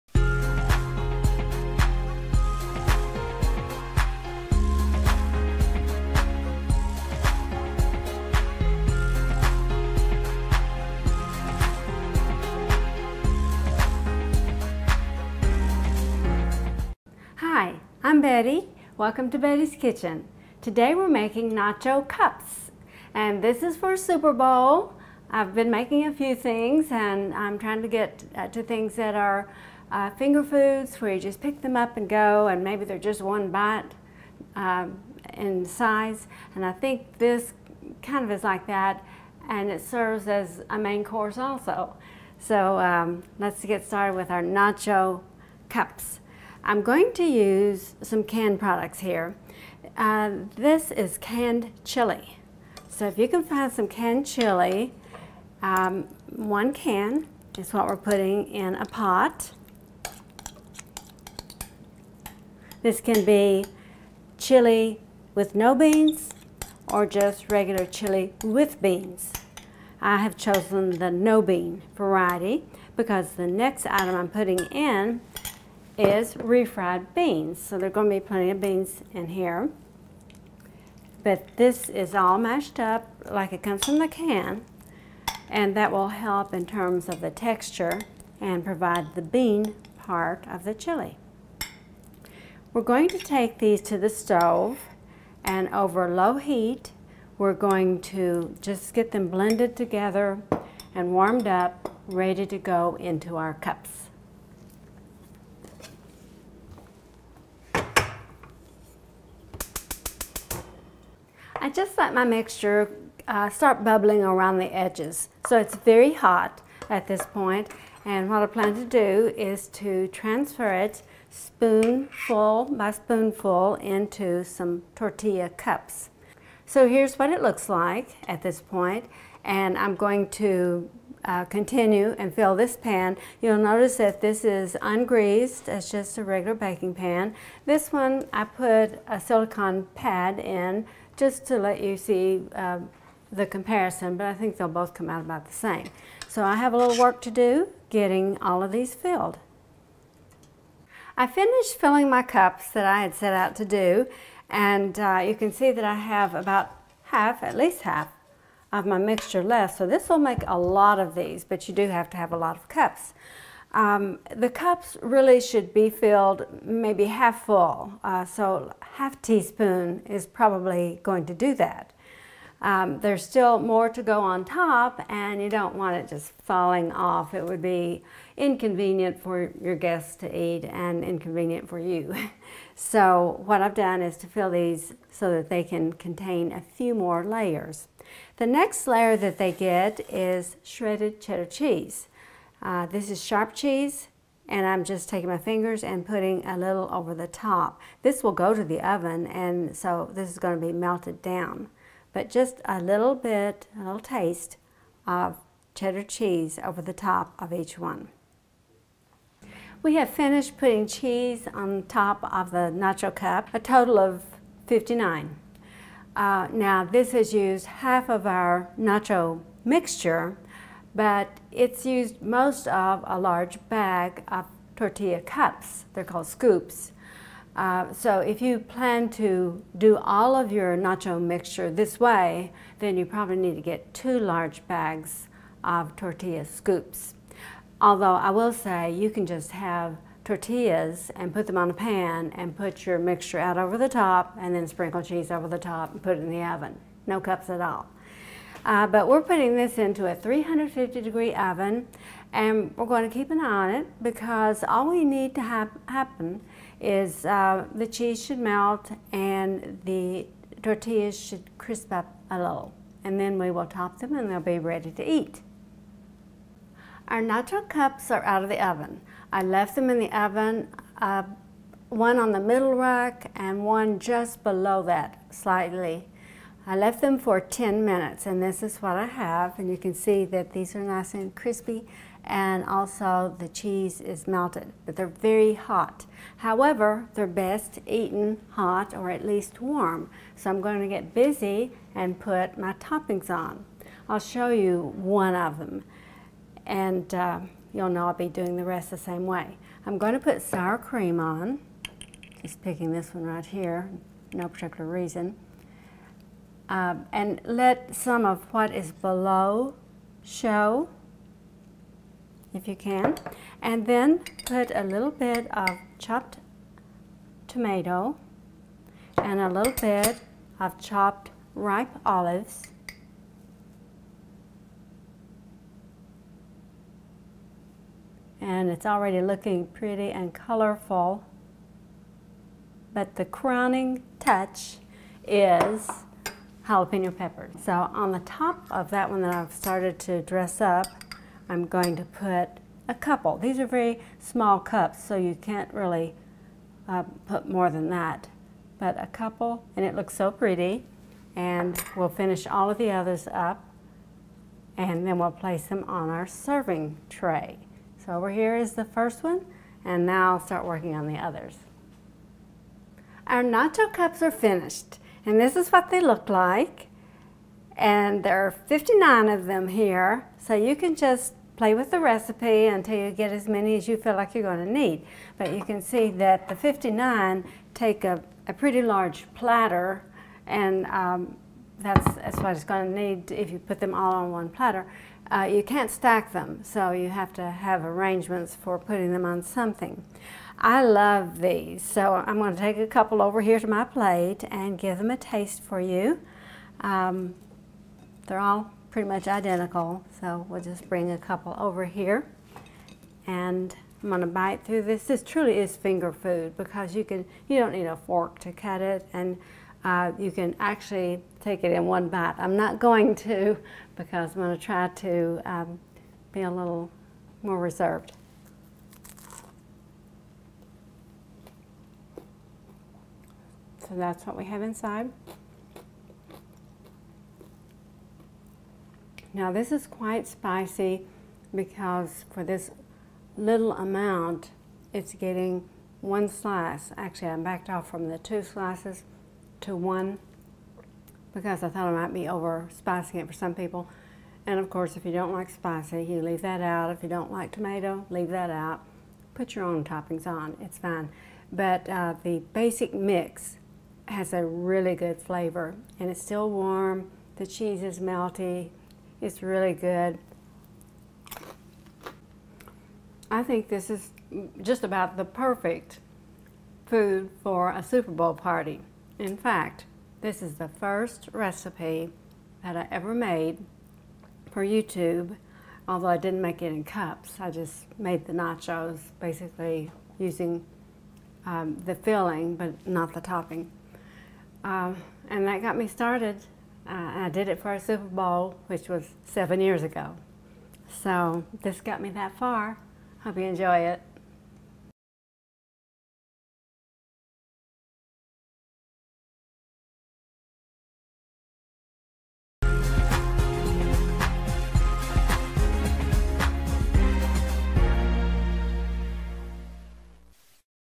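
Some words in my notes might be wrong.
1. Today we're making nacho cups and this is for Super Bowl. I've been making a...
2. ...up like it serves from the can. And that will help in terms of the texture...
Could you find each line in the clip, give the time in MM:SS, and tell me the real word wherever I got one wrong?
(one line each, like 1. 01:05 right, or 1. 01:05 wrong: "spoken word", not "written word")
1. 00:20 right
2. 01:22 wrong: "comes", not "serves".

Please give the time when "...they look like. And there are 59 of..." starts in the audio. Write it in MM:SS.
06:05.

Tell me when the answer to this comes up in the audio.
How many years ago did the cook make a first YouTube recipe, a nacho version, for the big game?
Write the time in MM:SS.
08:09.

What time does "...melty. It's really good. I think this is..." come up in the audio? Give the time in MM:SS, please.
07:37.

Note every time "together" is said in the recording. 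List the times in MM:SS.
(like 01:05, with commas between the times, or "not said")
01:39.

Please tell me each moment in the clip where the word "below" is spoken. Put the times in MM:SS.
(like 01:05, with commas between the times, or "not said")
04:34, 05:08.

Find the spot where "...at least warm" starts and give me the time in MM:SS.
04:49.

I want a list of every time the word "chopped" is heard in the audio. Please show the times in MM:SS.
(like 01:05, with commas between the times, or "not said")
05:15, 05:20.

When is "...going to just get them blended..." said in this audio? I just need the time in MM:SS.
01:37.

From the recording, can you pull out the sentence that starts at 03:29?
We have finished putting cheese on top of the nacho cup, a total of 59.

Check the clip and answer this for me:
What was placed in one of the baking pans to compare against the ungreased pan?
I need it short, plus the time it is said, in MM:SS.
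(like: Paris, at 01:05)
Silicone pad, at 02:19.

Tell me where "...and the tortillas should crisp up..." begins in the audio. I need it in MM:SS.
04:19.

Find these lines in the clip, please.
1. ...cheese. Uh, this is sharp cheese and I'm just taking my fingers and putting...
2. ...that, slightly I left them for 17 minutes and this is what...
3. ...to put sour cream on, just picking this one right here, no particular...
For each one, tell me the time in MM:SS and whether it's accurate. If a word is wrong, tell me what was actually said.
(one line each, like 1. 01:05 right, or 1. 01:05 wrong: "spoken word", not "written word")
1. 03:11 right
2. 04:34 wrong: "10", not "17"
3. 05:00 right.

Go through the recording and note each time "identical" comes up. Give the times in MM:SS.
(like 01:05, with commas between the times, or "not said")
06:39.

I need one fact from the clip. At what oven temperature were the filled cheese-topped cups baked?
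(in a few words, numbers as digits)
350 degrees.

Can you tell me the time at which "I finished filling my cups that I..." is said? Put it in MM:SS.
02:31.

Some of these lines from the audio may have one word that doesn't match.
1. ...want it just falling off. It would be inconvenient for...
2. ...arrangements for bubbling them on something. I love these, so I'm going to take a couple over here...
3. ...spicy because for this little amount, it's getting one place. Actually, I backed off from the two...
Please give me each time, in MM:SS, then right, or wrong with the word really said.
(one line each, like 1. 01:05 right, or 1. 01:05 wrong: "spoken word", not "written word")
1. 02:55 right
2. 06:27 wrong: "putting", not "bubbling"
3. 07:10 wrong: "slice", not "place".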